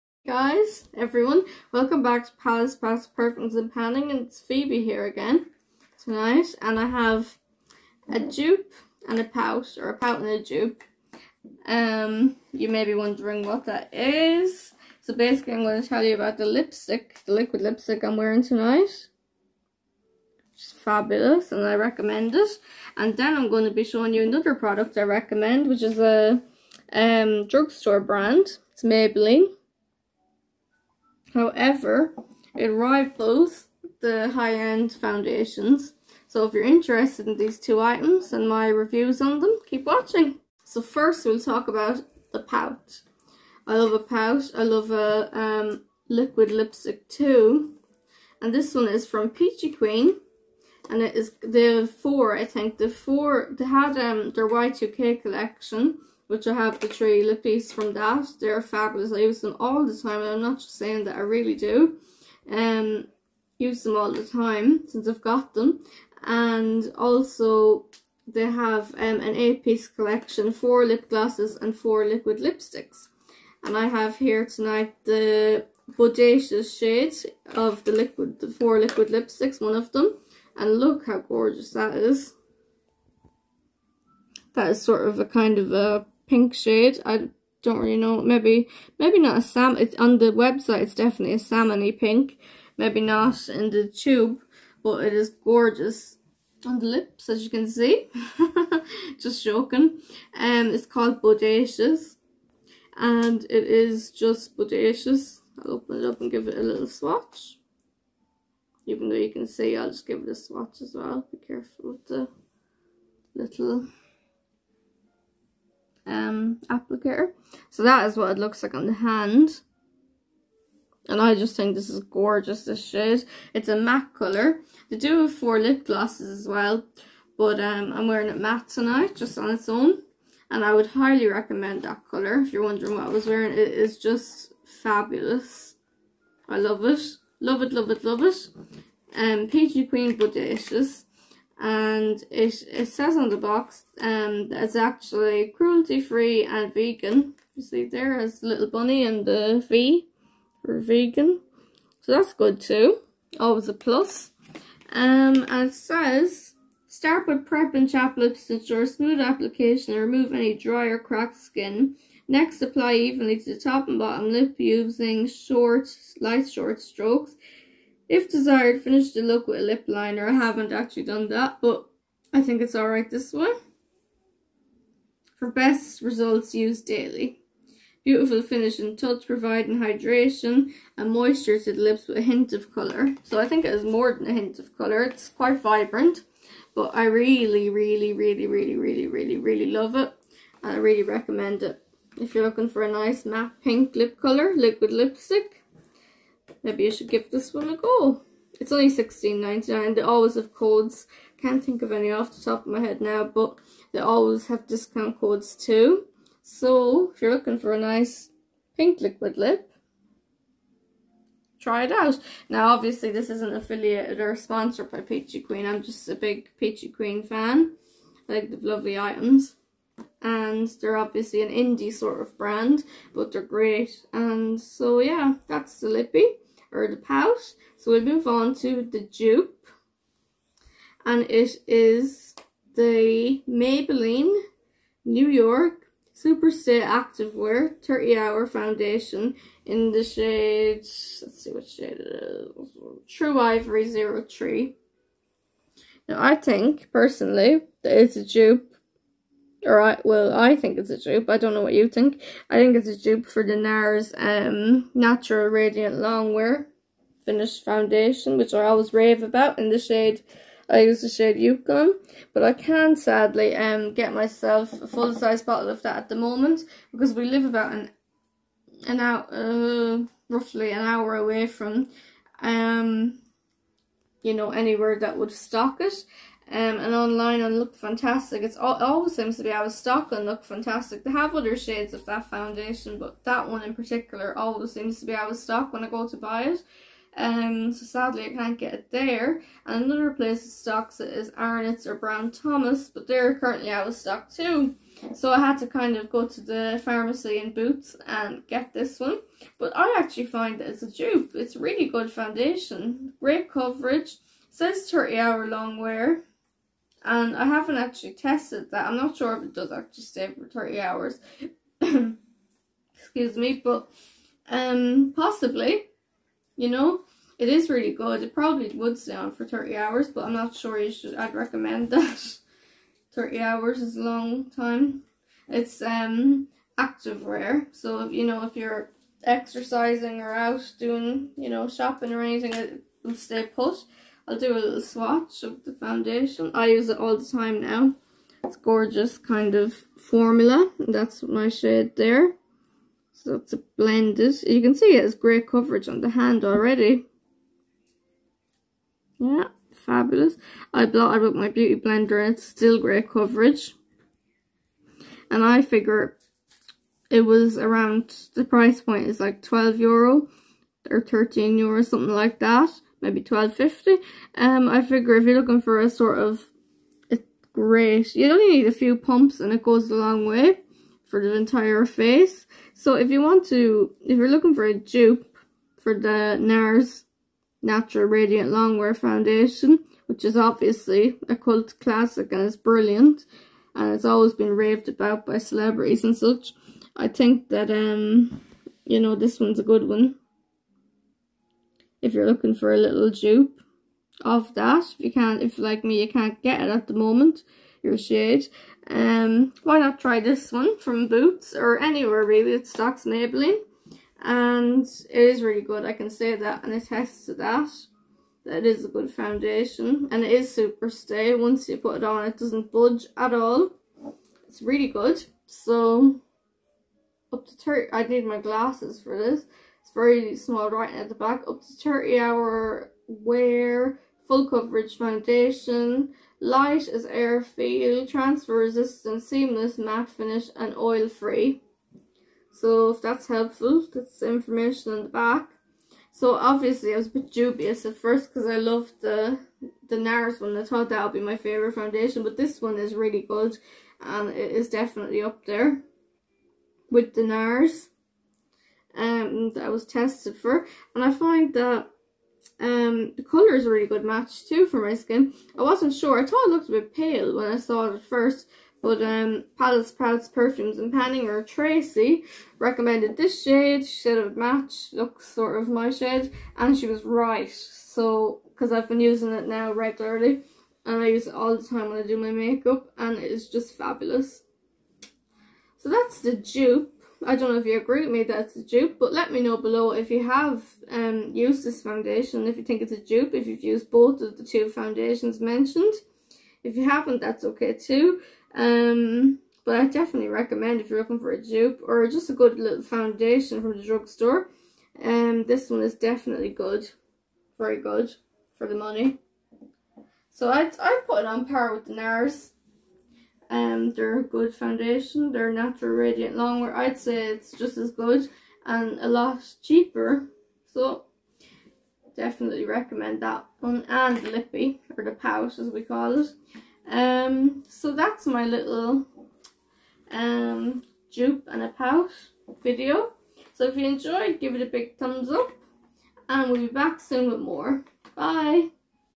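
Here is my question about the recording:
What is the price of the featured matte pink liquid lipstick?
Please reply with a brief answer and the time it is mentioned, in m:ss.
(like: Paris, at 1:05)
$16.99, at 3:18.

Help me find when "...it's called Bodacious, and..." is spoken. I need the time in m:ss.
1:40.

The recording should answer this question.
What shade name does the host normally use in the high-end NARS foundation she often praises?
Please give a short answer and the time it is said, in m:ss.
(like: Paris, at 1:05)
Yukon, at 4:21.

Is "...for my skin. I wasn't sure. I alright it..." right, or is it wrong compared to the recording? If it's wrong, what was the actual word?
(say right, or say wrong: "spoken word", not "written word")
wrong: "thought", not "alright".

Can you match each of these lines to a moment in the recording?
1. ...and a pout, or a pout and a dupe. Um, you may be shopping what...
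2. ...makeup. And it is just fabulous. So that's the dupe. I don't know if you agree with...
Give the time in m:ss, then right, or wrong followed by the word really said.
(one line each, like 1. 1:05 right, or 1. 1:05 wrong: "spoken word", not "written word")
1. 0:09 wrong: "wondering", not "shopping"
2. 7:52 right.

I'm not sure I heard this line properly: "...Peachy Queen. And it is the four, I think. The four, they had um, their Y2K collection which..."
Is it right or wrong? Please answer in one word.
right.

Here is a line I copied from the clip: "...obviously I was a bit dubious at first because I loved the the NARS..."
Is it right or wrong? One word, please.
right.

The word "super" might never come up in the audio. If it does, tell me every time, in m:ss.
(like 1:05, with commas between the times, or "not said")
3:56, 6:50.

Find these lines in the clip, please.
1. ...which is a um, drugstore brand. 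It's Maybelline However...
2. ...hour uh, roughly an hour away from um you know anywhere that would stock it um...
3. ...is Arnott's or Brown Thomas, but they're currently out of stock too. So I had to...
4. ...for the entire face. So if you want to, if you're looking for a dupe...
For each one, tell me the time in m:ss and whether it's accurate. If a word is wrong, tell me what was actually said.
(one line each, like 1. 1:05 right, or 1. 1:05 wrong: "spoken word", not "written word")
1. 0:25 right
2. 4:28 right
3. 4:51 right
4. 6:11 right.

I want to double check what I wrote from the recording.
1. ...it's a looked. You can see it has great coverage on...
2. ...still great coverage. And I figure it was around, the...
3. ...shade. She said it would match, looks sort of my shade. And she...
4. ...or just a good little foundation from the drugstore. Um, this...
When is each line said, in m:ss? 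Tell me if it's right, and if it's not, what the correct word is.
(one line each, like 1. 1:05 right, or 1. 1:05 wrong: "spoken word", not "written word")
1. 5:43 wrong: "blended", not "looked"
2. 5:52 right
3. 7:43 right
4. 8:11 right.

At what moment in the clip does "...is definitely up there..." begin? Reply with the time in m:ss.
7:24.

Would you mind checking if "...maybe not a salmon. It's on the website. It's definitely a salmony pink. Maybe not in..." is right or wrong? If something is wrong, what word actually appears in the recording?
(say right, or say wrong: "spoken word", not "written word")
right.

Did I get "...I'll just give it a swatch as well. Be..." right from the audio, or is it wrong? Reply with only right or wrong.
right.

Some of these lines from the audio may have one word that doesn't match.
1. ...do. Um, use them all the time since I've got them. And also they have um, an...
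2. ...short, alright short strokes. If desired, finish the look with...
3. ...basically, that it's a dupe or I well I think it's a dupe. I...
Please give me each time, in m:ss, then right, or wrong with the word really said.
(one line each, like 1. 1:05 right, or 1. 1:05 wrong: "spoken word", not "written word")
1. 1:01 right
2. 2:45 wrong: "light", not "alright"
3. 4:06 wrong: "personally", not "basically".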